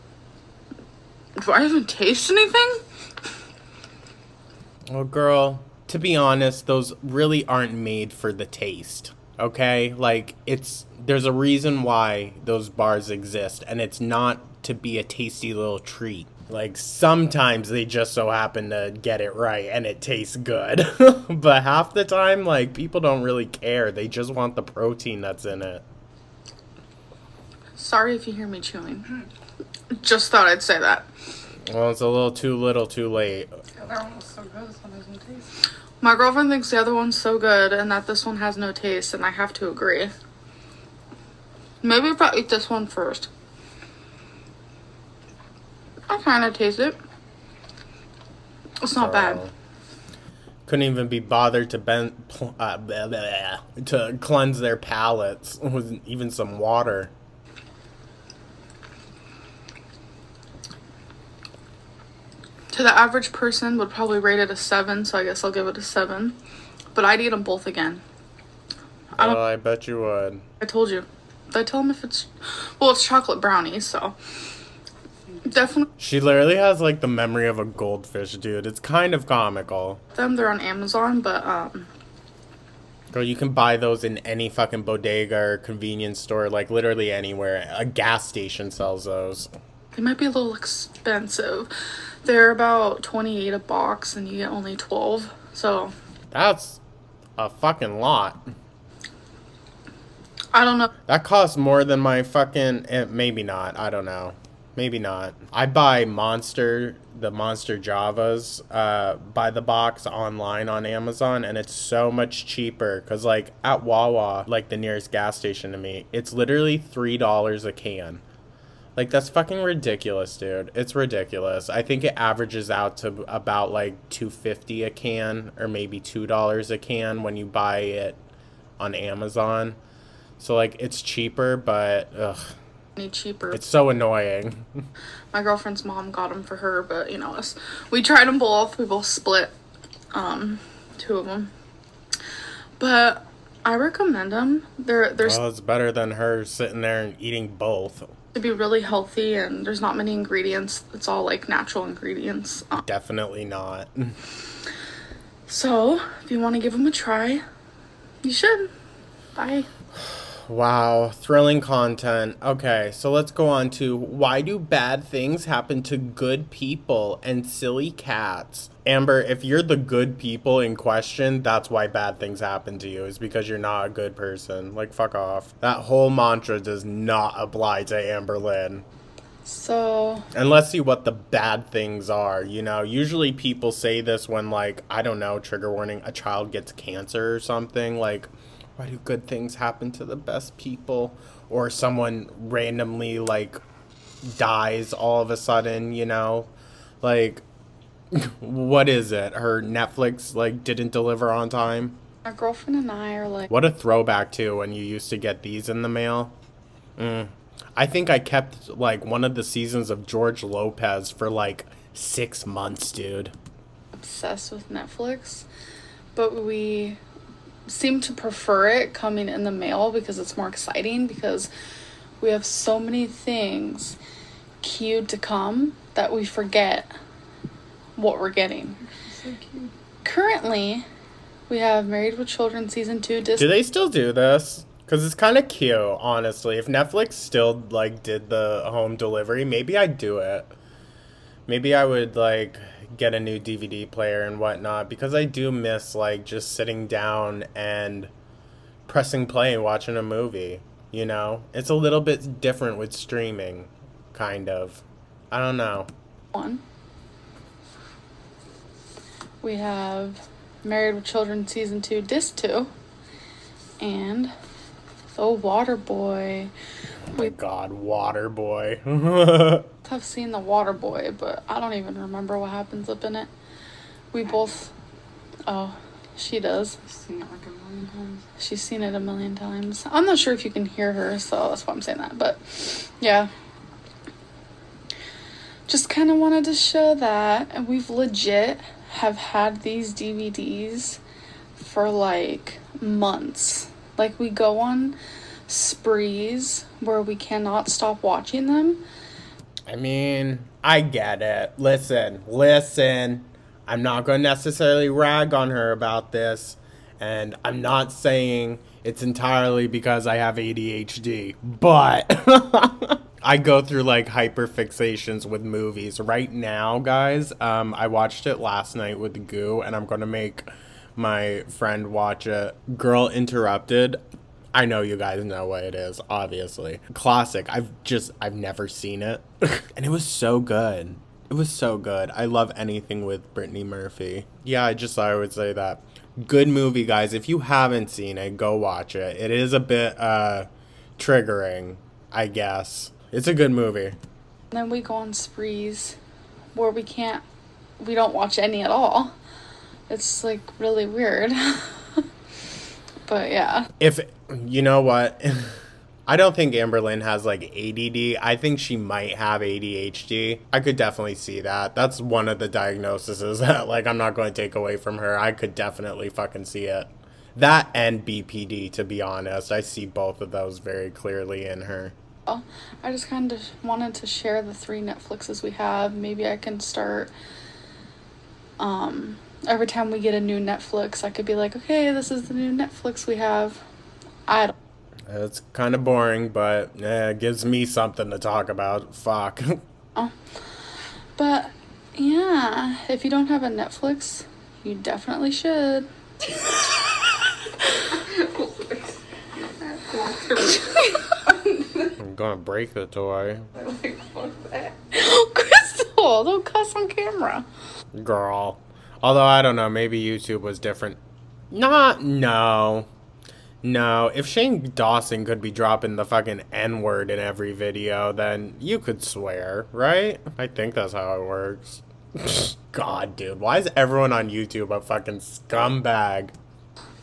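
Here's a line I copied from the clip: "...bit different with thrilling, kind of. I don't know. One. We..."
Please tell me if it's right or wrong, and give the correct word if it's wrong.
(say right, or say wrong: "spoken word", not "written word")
wrong: "streaming", not "thrilling".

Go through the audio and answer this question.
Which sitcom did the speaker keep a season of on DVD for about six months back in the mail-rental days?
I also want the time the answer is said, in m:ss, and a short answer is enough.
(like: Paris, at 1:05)
George Lopez, at 3:30.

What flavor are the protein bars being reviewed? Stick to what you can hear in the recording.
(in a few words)
Chocolate brownie.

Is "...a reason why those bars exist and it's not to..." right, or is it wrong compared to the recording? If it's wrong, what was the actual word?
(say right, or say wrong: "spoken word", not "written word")
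right.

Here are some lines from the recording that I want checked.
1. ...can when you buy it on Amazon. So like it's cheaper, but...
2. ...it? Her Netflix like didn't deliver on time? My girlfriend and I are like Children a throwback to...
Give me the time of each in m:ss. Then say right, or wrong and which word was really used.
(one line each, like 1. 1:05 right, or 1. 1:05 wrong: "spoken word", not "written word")
1. 2:06 right
2. 3:19 wrong: "What", not "Children".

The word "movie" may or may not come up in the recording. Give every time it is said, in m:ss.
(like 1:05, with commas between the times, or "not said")
4:10, 5:15, 5:36, 5:43.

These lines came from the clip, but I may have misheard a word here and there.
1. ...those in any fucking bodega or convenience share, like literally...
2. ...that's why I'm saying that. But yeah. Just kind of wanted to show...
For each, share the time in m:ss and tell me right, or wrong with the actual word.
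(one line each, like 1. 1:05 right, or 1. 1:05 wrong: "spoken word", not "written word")
1. 1:23 wrong: "store", not "share"
2. 4:41 right.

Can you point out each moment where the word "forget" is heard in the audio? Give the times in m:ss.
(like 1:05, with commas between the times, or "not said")
3:46.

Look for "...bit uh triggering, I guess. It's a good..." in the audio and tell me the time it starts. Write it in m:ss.
5:39.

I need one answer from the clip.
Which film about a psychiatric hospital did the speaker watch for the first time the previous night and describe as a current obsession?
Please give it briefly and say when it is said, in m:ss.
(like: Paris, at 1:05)
Girl, Interrupted, at 5:22.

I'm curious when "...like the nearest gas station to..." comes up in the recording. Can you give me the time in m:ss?
1:54.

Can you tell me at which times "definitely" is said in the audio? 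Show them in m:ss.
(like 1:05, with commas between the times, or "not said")
1:15, 2:32, 6:00, 6:05, 6:34.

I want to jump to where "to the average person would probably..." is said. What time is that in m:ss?
1:02.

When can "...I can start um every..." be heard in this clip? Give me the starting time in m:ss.
6:16.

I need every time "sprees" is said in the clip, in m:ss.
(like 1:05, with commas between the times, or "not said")
4:55, 5:45.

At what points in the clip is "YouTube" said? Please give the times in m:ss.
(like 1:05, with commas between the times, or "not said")
6:50, 7:04.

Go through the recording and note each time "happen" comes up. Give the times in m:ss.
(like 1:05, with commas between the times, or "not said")
0:18, 2:45, 2:52, 3:09, 4:32.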